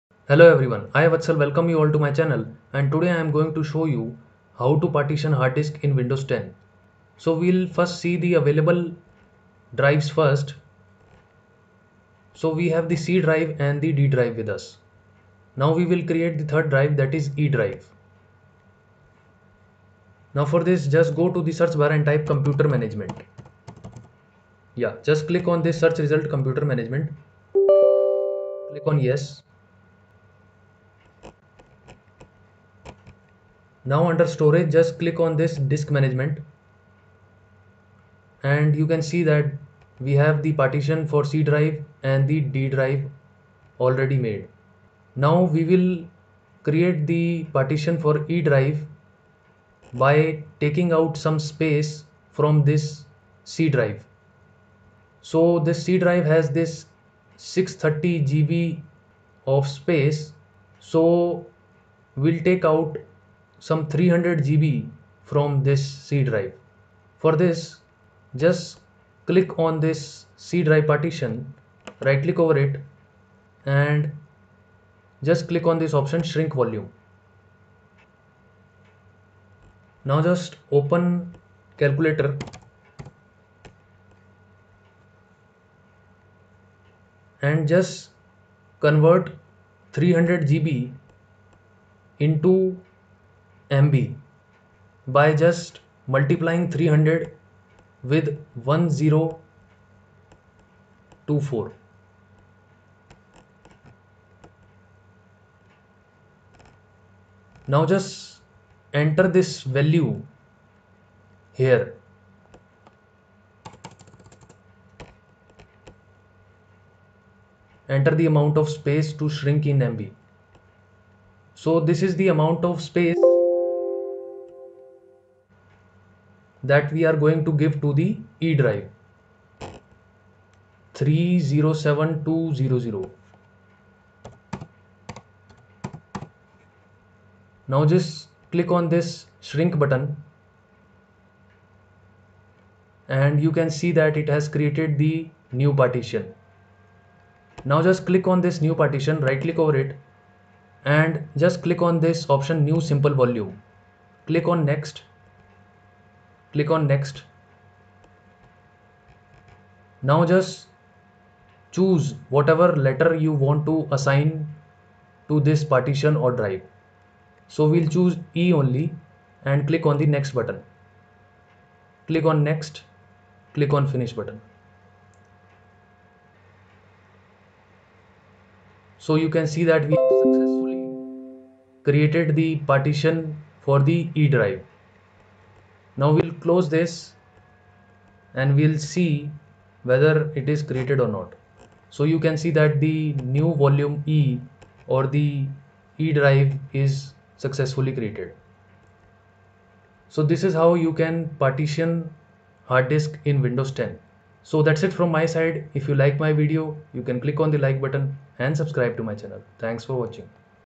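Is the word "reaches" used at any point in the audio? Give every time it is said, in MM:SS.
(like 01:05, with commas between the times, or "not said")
not said.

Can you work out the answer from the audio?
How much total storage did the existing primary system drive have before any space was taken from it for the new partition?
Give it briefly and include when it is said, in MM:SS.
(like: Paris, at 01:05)
630 GB, at 00:57.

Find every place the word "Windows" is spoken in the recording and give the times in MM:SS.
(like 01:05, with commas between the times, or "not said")
00:05, 03:23.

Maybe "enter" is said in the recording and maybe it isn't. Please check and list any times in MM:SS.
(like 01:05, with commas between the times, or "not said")
01:49, 01:57.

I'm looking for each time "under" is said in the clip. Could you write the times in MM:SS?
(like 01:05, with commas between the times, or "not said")
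00:34.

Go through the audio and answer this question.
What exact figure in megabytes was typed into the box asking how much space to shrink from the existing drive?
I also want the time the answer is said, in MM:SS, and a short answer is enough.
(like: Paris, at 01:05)
307200, at 02:10.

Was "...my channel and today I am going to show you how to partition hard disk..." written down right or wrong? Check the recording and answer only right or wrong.
right.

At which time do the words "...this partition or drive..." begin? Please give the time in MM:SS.
02:45.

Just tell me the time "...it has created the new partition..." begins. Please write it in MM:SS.
02:24.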